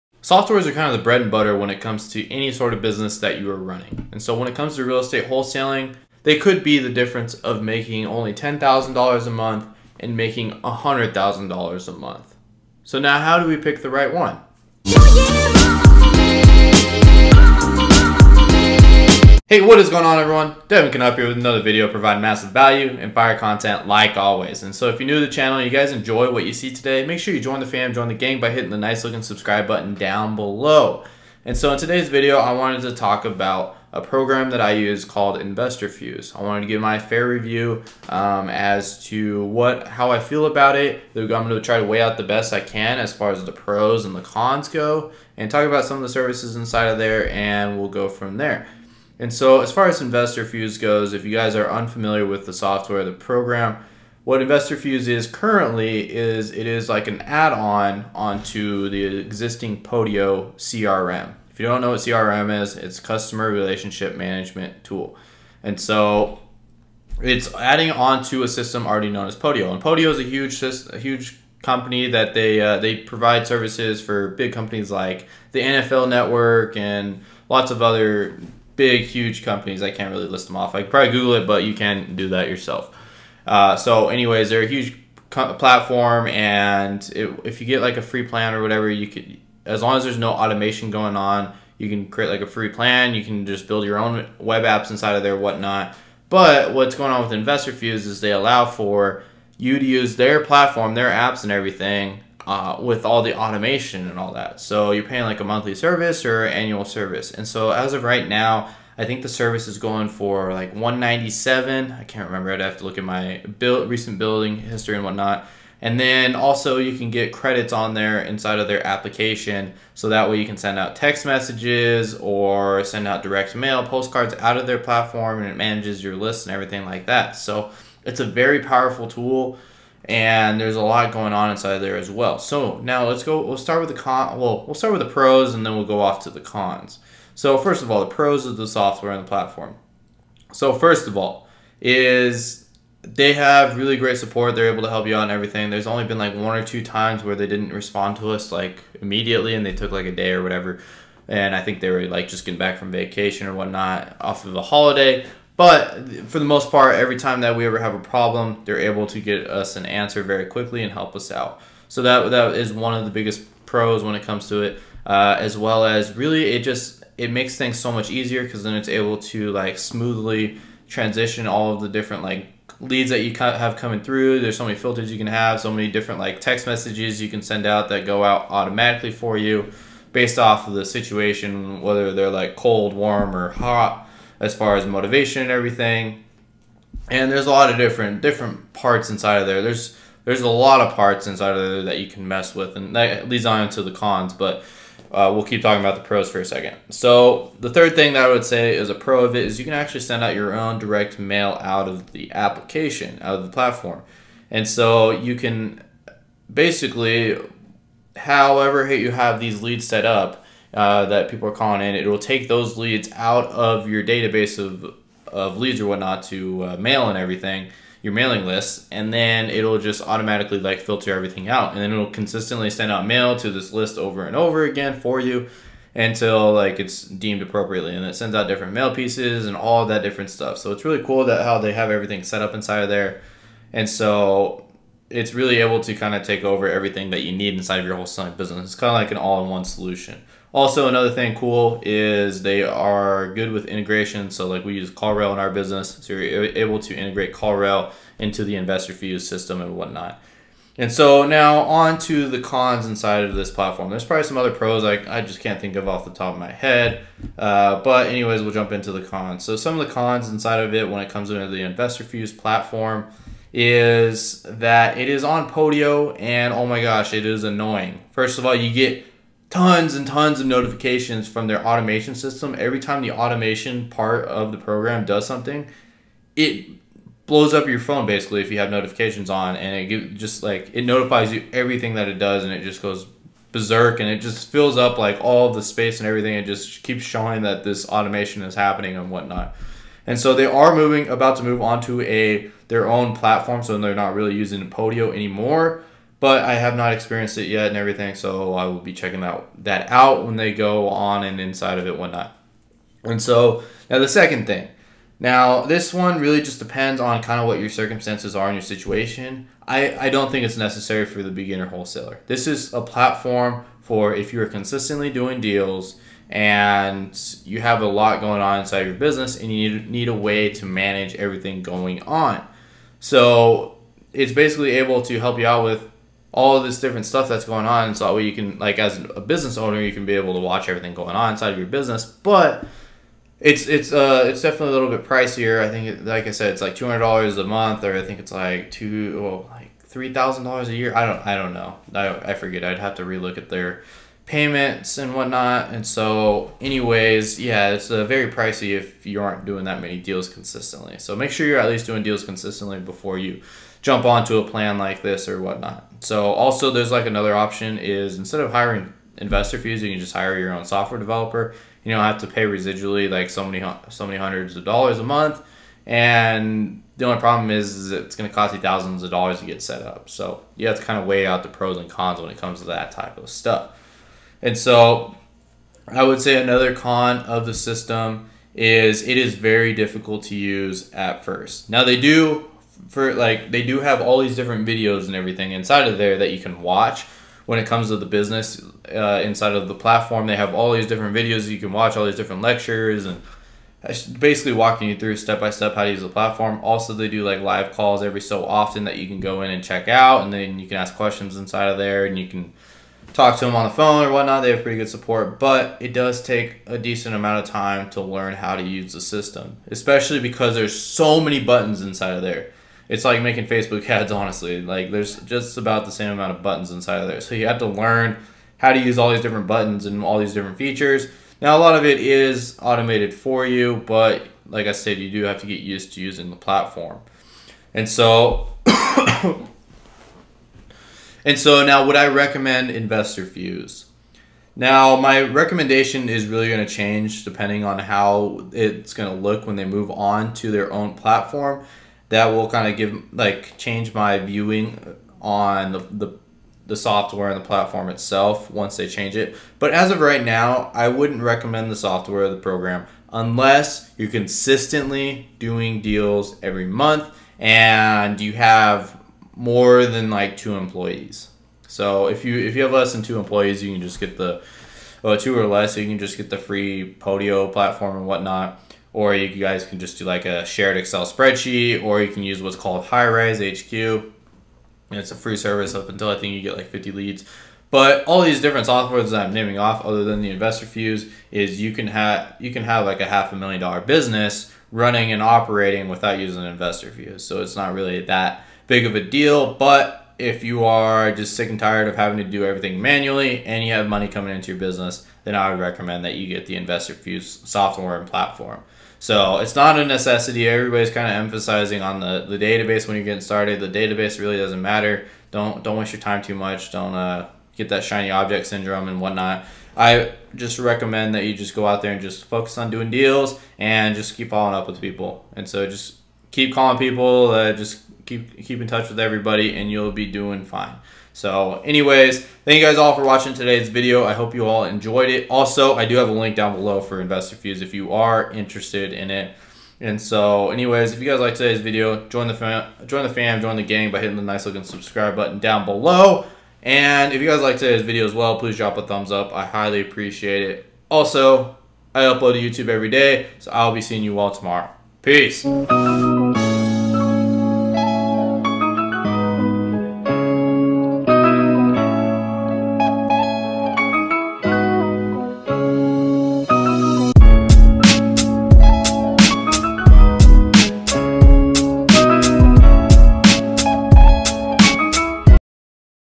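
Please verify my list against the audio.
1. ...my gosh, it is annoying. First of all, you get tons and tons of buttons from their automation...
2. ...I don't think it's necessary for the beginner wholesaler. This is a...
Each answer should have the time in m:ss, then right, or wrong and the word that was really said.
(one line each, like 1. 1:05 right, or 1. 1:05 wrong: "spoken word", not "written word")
1. 4:26 wrong: "notifications", not "buttons"
2. 5:09 right.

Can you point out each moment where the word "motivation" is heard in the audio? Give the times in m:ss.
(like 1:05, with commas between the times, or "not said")
3:04.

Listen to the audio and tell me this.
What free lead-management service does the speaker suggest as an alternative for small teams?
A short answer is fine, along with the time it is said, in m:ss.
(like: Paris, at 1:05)
Highrise HQ, at 7:52.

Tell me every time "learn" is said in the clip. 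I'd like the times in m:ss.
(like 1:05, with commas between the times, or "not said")
6:47, 6:57.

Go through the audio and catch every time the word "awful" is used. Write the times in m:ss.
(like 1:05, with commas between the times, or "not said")
not said.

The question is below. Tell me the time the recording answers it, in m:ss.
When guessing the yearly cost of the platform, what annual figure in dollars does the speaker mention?
5:39.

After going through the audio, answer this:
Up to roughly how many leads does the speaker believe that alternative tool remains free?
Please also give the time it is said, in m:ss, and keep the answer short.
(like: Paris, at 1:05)
50, at 7:56.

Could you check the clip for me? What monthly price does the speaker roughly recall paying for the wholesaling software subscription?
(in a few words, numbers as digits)
197.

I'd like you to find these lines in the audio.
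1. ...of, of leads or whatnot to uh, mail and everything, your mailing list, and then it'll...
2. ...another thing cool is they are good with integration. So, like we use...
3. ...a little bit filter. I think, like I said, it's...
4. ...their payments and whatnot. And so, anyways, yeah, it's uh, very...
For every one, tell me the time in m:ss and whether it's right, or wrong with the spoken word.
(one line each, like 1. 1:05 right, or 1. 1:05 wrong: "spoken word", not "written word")
1. 3:34 right
2. 4:00 right
3. 5:34 wrong: "pricier", not "filter"
4. 5:43 right.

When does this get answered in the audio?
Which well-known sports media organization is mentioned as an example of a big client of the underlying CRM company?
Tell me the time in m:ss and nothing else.
1:15.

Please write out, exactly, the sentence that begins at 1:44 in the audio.
So you're paying like a monthly service or annual service.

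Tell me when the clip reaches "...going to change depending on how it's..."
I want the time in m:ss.
7:16.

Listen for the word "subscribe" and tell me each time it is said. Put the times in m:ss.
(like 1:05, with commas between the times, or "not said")
0:29, 8:54.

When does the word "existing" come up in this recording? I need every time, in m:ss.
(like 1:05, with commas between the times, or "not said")
0:59.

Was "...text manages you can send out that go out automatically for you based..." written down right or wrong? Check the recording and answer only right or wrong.
wrong.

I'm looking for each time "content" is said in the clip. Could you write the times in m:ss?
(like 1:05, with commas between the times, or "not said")
0:23.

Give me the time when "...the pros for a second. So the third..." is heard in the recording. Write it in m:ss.
3:15.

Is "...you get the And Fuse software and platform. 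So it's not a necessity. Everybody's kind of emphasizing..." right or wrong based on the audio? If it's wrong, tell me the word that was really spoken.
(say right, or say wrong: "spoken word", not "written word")
wrong: "Investor", not "And".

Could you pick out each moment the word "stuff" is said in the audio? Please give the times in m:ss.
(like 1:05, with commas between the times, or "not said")
3:50, 5:27, 6:13.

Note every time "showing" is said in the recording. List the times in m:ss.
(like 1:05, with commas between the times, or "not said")
4:47.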